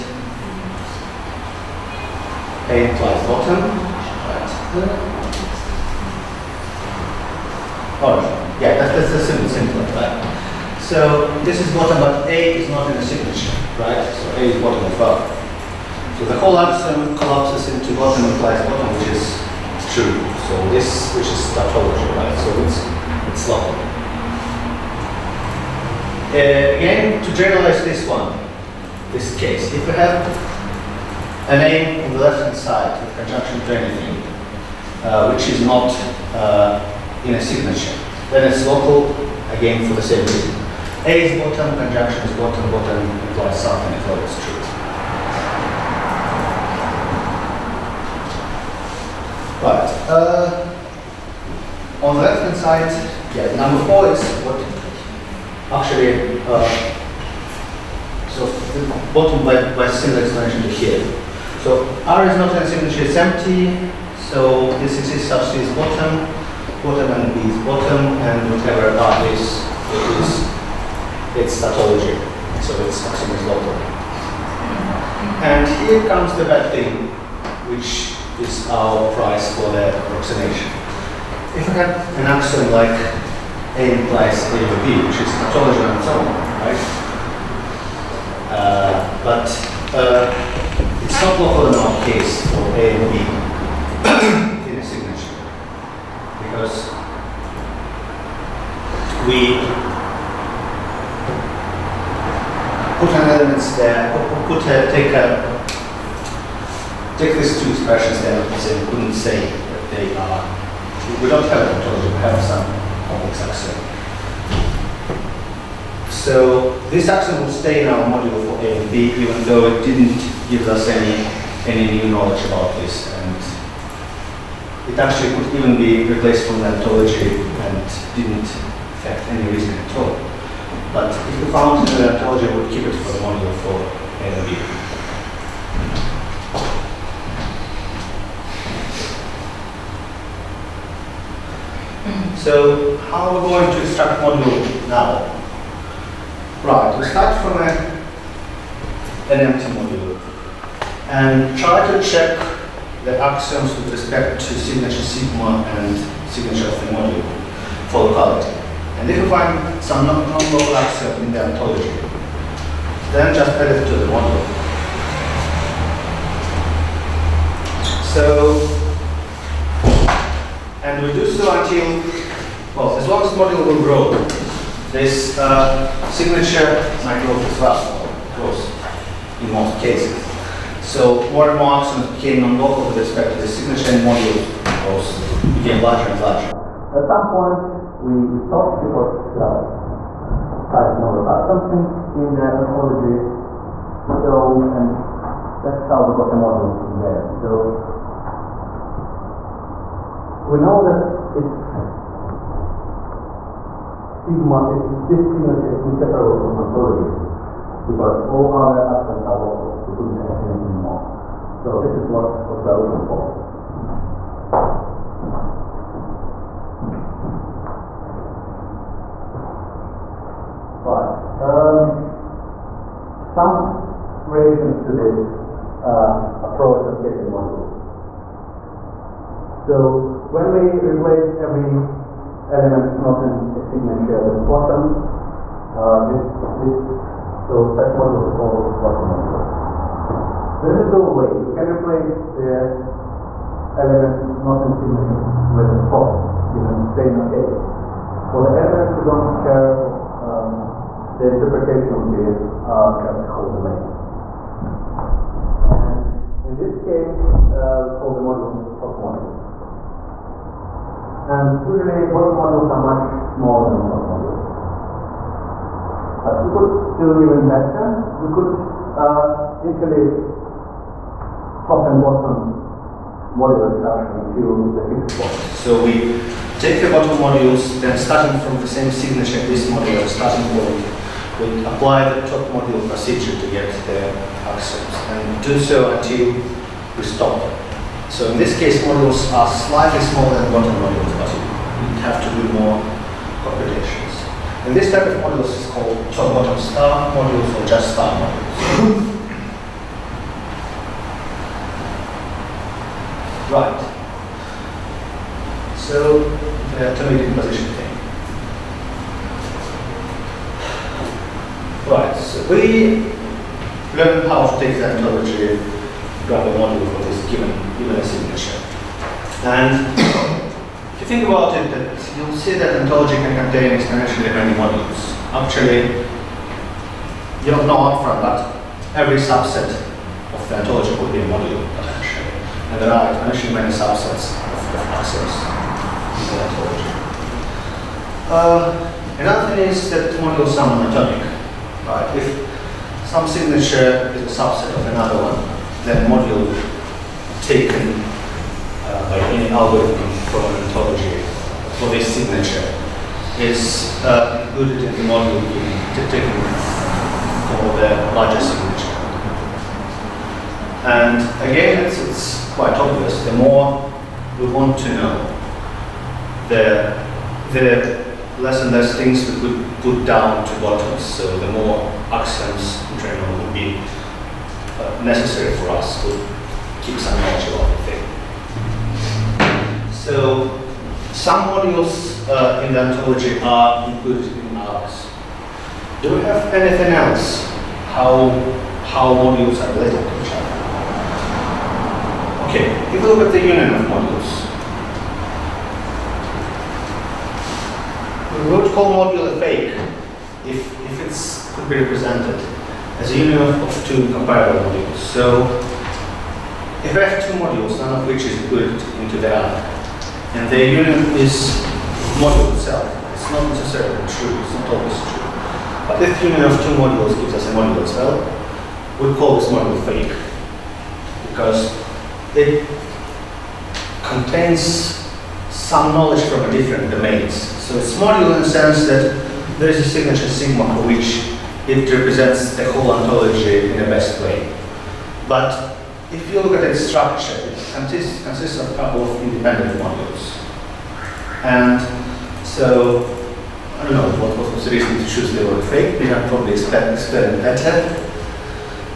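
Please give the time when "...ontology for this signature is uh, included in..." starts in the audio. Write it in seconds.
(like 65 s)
350 s.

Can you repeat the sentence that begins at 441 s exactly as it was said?
And so, I don't know what, what was the reason to choose the word fake.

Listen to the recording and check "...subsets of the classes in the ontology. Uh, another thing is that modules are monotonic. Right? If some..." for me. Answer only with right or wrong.
right.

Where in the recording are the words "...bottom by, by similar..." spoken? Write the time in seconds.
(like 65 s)
59 s.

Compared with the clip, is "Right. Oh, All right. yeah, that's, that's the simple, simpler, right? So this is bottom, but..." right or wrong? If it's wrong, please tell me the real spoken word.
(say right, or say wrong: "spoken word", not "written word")
right.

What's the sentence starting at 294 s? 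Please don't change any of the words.
And this type of modules is called top-bottom star modules or just star modules.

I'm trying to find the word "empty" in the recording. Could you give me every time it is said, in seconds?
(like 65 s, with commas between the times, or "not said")
63 s, 149 s.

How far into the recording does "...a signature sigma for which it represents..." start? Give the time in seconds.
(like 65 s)
429 s.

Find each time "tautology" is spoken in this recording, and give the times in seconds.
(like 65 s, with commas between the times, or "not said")
21 s, 71 s, 85 s.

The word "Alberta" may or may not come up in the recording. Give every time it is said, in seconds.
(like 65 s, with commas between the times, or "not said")
not said.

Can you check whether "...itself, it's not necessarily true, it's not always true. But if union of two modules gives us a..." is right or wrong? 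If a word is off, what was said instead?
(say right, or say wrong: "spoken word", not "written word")
right.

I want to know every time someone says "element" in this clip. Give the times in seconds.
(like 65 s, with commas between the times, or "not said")
103 s, 232 s, 243 s, 248 s.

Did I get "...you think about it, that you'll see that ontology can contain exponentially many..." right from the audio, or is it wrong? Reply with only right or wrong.
right.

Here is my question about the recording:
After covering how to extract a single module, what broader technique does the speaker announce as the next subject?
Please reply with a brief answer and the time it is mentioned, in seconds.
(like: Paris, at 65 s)
atomic decomposition, at 306 s.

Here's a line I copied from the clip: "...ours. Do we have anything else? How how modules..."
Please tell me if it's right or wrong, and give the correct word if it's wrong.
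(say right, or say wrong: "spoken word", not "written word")
right.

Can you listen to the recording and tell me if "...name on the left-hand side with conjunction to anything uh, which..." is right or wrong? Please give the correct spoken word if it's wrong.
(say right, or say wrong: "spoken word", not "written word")
right.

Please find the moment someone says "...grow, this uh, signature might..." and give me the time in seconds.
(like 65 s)
173 s.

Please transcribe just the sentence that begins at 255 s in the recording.
And in this case, uh, we call the modules top modules.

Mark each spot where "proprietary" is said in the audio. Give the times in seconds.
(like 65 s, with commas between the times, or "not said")
not said.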